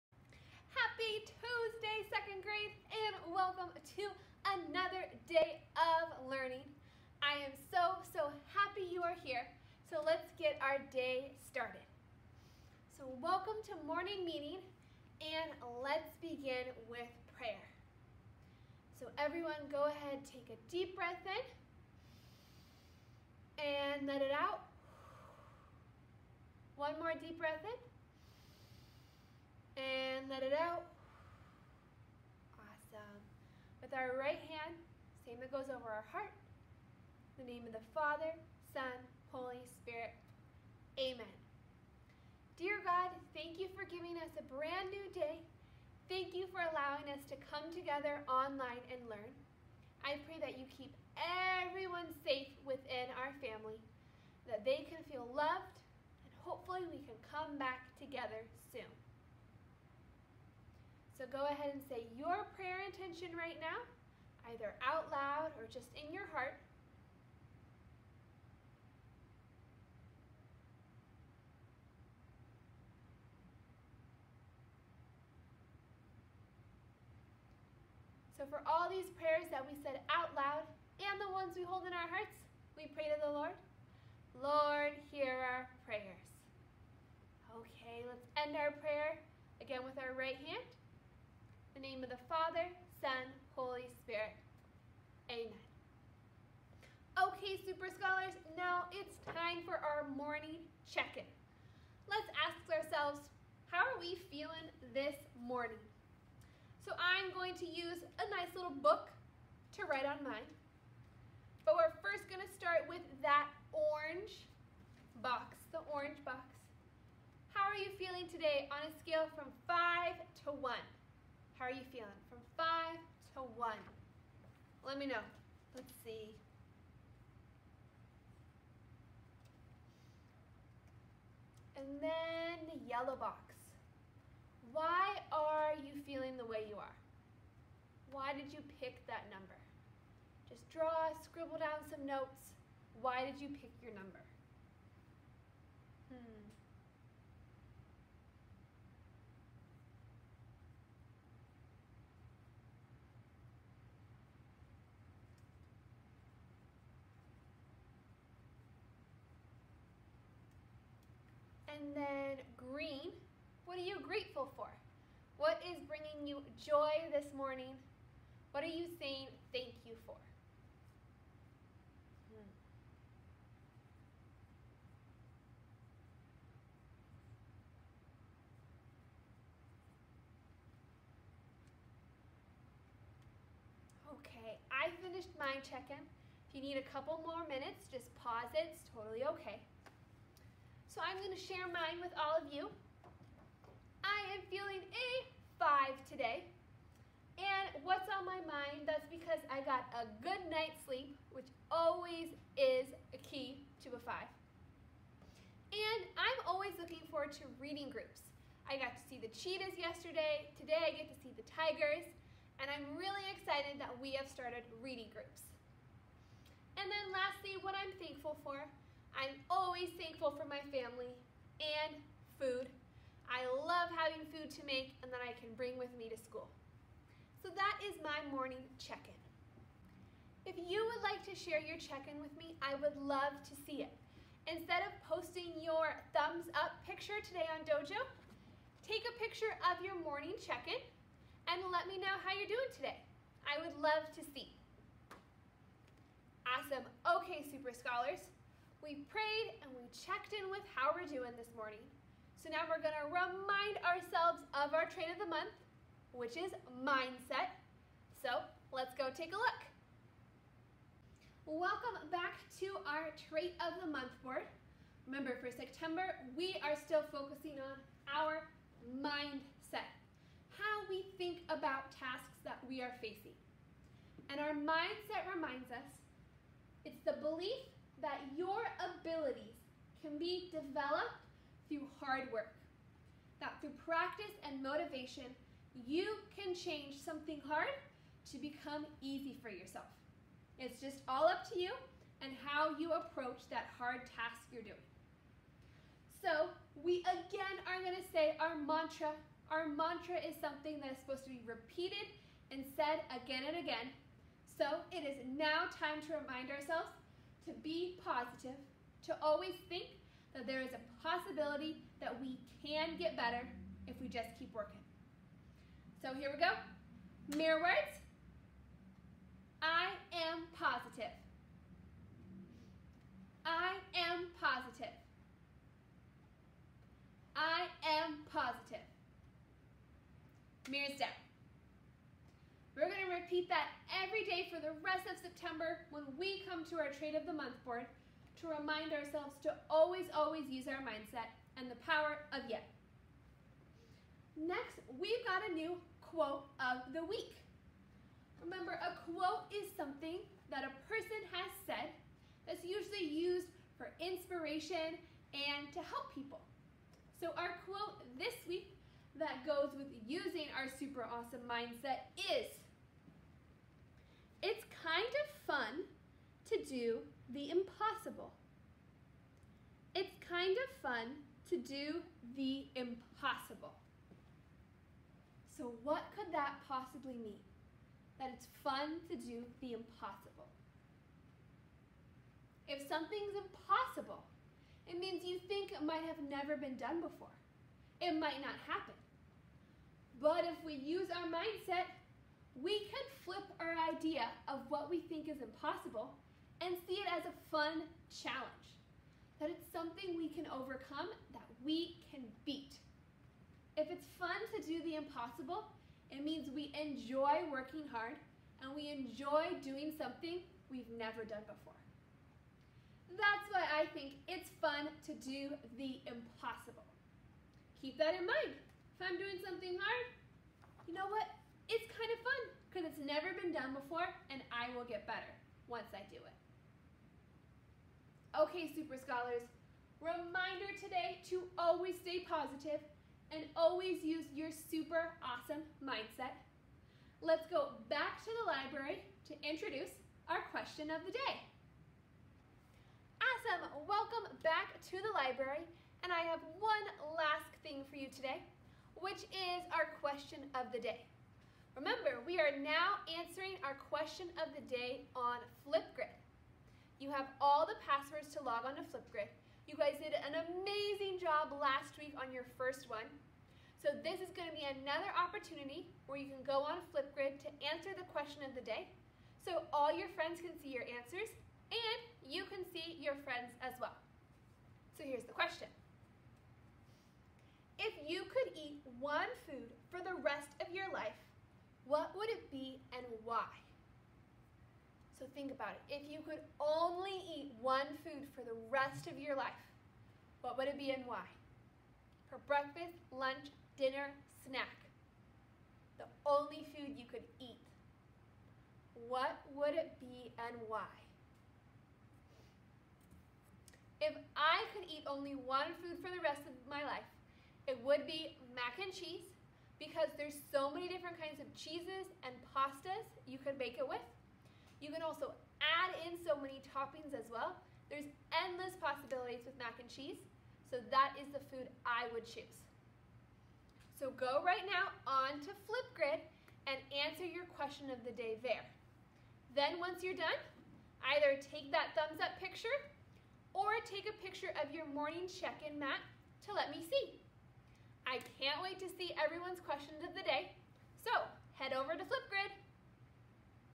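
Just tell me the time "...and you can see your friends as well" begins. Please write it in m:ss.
7:51.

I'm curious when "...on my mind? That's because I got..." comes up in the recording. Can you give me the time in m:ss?
3:18.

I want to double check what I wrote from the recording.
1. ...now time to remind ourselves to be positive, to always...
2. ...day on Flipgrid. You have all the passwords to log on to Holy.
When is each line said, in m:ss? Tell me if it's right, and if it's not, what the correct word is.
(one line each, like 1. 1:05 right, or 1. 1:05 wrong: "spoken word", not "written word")
1. 5:05 right
2. 7:34 wrong: "Flipgrid", not "Holy".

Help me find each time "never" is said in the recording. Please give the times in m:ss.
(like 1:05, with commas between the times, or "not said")
6:26, 6:50, 7:03.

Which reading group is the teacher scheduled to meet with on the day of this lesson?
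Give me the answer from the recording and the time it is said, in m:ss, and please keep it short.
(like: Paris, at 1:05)
Tigers, at 3:31.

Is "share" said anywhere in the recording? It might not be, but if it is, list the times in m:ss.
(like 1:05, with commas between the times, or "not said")
3:11, 3:51.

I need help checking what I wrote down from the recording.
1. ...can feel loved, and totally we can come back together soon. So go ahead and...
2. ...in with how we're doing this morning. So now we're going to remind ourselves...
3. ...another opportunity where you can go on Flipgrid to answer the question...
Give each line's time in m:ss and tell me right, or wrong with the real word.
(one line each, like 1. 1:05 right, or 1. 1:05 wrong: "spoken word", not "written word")
1. 0:54 wrong: "hopefully", not "totally"
2. 4:10 right
3. 7:44 right.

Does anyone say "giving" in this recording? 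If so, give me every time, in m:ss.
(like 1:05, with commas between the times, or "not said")
0:43.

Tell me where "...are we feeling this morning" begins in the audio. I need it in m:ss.
1:43.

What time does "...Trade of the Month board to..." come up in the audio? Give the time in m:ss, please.
5:36.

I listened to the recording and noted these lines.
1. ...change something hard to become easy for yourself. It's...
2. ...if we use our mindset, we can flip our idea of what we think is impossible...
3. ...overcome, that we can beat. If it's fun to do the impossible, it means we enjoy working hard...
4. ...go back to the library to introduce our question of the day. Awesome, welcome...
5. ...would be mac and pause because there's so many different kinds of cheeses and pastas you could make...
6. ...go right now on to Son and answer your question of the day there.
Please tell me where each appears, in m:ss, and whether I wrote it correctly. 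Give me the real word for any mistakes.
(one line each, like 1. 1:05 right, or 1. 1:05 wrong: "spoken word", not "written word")
1. 4:46 right
2. 6:30 right
3. 6:40 right
4. 7:17 right
5. 8:27 wrong: "cheese", not "pause"
6. 8:44 wrong: "Flipgrid", not "Son".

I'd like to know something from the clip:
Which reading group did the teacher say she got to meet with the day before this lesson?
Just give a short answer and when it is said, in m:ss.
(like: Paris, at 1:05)
Cheetahs, at 3:29.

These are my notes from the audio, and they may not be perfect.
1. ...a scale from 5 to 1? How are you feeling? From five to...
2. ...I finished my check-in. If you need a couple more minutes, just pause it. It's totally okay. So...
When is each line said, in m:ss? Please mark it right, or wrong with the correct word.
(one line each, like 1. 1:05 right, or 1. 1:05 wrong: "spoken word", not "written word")
1. 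1:58 right
2. 3:04 right.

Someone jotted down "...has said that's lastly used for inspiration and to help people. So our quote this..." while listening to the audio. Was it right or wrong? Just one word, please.
wrong.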